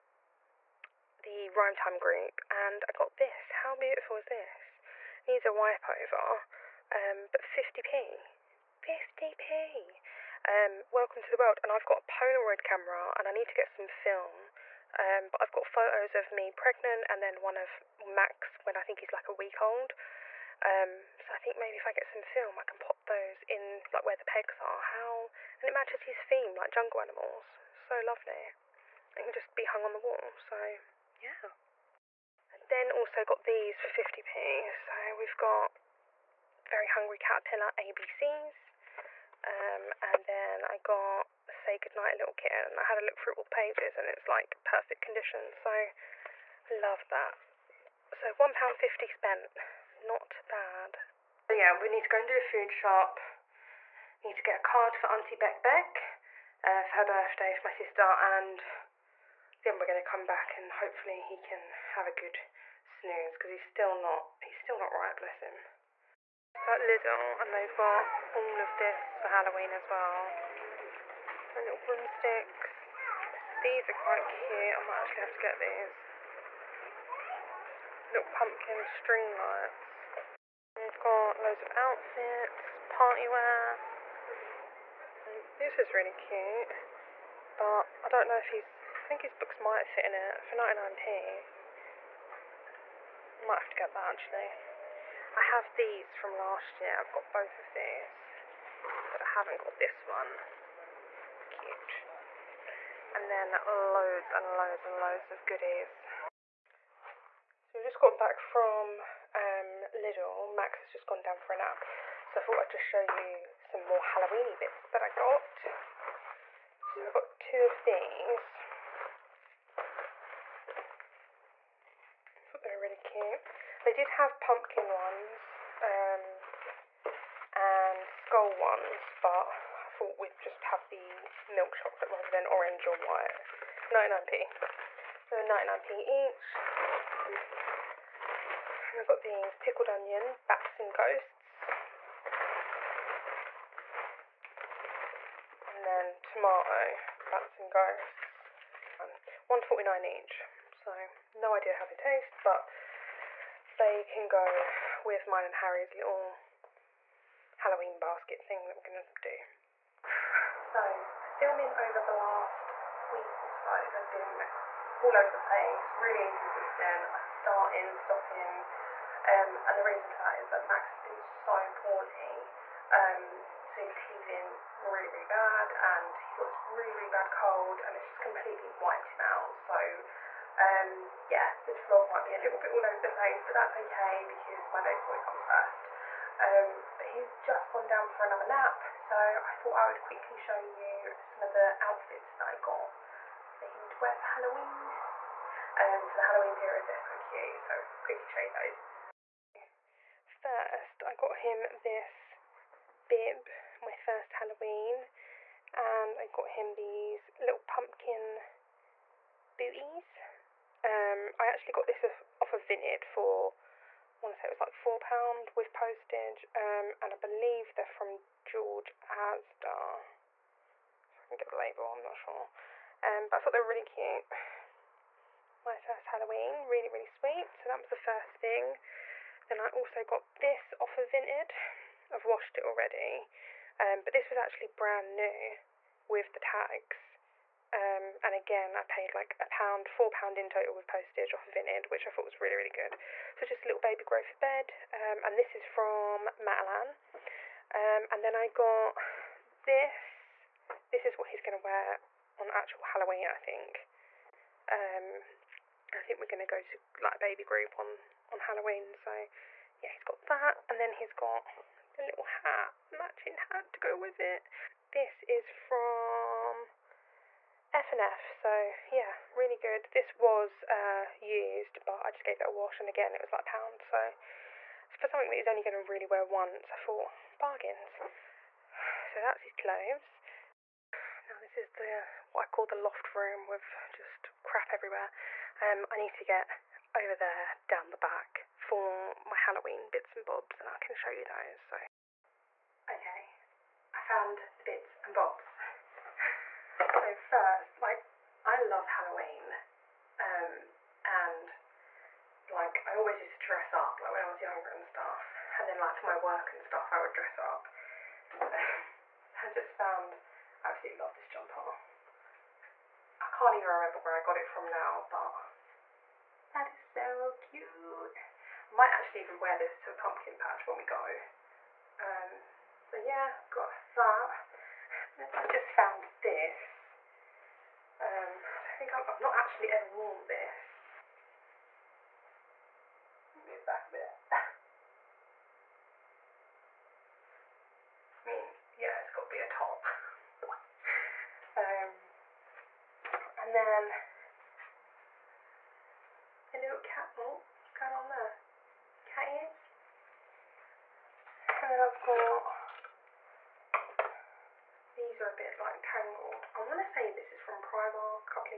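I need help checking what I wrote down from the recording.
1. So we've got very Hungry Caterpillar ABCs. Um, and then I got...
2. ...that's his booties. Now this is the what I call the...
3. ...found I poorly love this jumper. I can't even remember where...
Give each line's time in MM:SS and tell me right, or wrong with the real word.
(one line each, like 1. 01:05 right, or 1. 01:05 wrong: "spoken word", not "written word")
1. 00:34 right
2. 04:39 wrong: "clothes", not "booties"
3. 05:09 wrong: "absolutely", not "poorly".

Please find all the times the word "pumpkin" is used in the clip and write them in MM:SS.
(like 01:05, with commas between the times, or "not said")
01:18, 02:04, 03:27, 05:19.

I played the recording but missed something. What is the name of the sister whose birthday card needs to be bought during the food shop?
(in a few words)
Auntie Beck Beck.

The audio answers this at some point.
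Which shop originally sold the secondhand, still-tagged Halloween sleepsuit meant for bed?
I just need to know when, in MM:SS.
04:06.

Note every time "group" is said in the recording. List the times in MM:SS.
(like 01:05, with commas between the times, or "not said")
00:01, 04:17.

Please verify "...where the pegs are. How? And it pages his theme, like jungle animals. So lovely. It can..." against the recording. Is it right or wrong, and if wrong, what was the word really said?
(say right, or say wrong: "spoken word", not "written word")
wrong: "matches", not "pages".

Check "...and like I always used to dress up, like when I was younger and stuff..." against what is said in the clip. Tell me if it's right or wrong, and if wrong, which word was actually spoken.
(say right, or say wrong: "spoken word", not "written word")
right.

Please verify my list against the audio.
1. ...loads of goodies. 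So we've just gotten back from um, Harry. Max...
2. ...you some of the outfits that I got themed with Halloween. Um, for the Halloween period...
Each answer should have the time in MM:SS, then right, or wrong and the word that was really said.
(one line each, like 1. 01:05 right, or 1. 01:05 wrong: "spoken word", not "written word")
1. 01:44 wrong: "Lidl", not "Harry"
2. 03:10 right.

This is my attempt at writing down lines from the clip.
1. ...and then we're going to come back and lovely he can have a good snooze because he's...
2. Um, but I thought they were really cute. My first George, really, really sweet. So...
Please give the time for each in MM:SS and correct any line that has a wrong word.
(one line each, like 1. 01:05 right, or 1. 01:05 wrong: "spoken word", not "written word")
1. 00:58 wrong: "hopefully", not "lovely"
2. 03:43 wrong: "Halloween", not "George".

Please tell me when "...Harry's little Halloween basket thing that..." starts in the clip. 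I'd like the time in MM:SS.
02:35.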